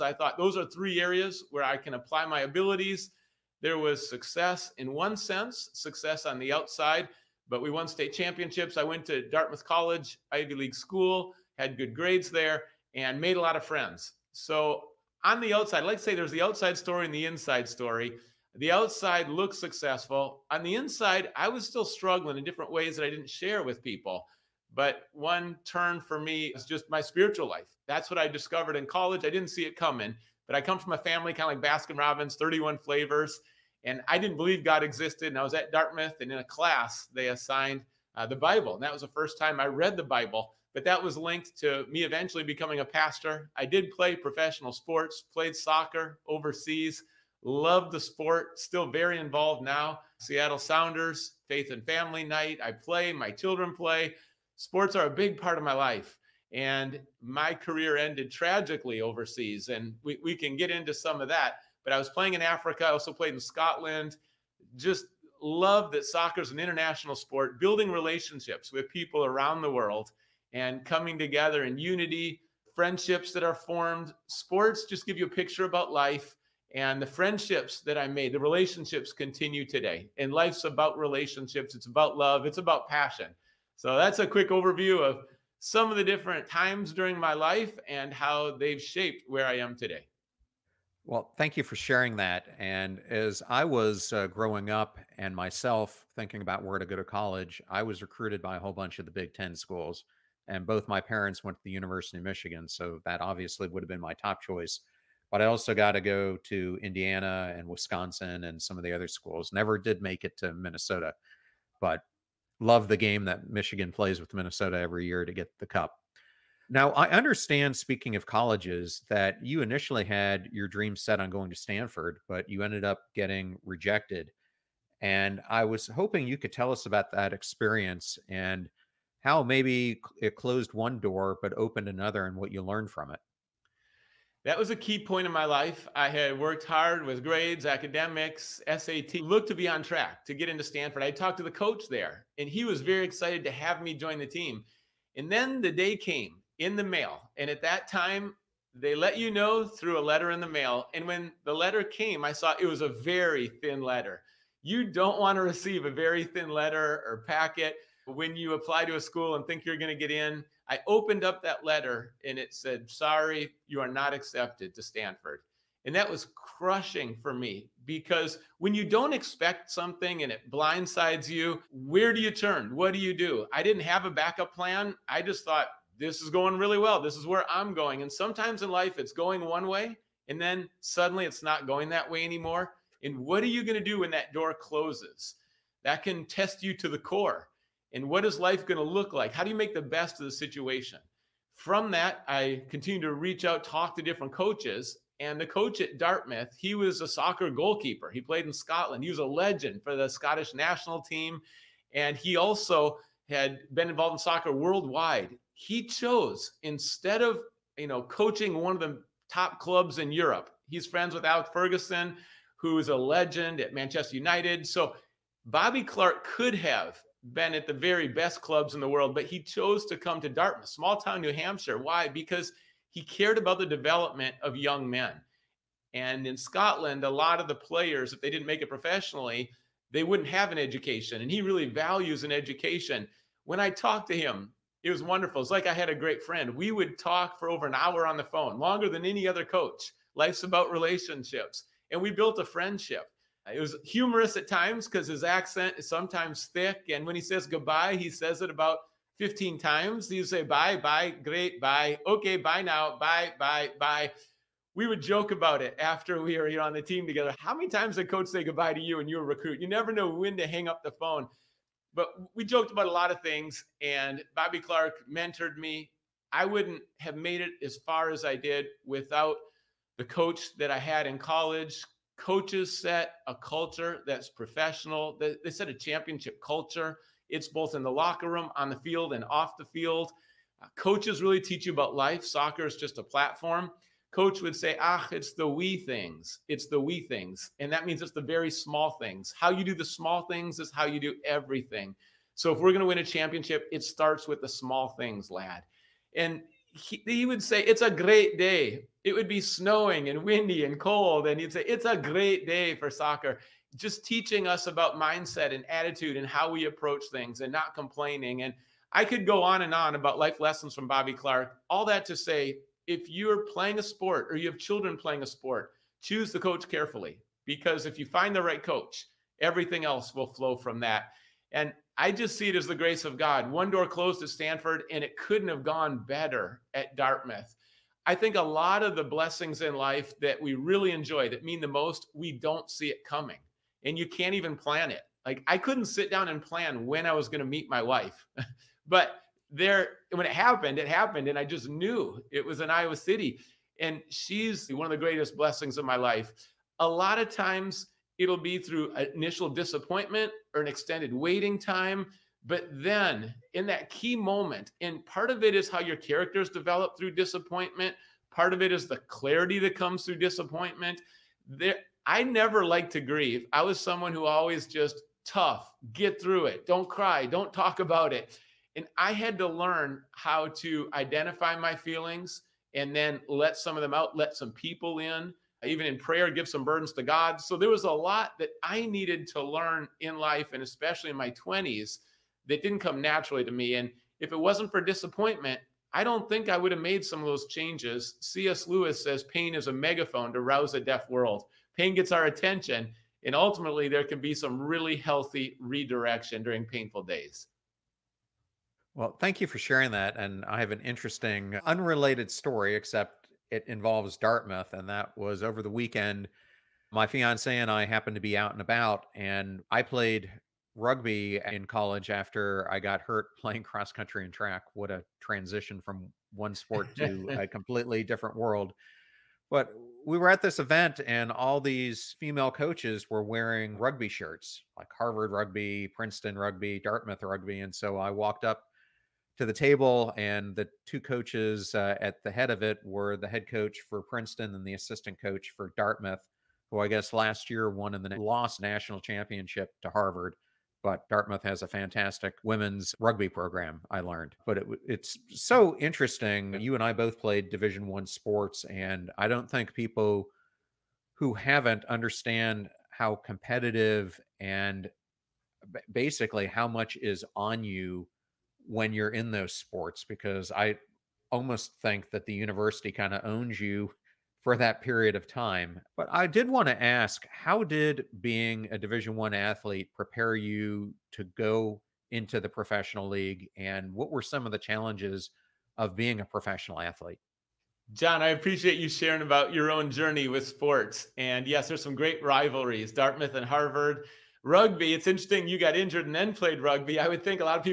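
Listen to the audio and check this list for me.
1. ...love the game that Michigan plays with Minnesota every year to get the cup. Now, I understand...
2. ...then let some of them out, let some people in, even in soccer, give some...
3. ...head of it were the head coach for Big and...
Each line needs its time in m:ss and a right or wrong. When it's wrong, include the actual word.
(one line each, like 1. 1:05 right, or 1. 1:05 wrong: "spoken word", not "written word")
1. 1:52 right
2. 6:12 wrong: "prayer", not "soccer"
3. 7:12 wrong: "Princeton", not "Big".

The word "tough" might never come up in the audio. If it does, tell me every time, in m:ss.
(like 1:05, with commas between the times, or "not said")
6:05.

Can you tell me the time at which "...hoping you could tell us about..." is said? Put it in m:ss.
2:05.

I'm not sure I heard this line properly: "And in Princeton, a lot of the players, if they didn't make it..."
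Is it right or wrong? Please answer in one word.
wrong.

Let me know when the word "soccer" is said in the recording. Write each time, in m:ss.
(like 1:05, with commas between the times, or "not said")
0:45, 1:06, 3:17, 3:24, 4:42, 5:02.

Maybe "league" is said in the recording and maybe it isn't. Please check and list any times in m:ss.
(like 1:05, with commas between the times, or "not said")
0:10, 7:53.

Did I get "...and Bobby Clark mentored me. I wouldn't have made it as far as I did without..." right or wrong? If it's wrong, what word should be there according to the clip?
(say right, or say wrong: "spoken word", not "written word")
right.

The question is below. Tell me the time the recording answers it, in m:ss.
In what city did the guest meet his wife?
5:42.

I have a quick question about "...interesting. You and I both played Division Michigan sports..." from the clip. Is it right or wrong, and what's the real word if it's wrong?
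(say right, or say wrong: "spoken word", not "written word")
wrong: "One", not "Michigan".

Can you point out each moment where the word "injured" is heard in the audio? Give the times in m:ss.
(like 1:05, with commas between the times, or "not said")
8:05.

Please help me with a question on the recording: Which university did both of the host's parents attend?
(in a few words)
University of Michigan.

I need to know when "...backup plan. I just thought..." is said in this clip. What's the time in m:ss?
2:54.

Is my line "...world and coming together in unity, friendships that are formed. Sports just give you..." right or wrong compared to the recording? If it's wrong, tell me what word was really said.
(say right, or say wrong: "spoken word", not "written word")
right.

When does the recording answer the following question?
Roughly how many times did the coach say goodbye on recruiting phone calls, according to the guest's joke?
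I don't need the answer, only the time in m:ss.
4:09.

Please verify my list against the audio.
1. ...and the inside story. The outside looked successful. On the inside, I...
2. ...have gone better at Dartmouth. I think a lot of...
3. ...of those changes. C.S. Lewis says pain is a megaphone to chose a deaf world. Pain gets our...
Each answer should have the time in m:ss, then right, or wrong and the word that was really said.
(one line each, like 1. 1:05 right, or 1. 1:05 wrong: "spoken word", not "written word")
1. 0:17 right
2. 5:25 right
3. 6:27 wrong: "rouse", not "chose".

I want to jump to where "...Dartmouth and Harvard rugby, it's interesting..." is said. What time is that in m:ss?
8:02.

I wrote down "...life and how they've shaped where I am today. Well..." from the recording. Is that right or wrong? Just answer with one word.
right.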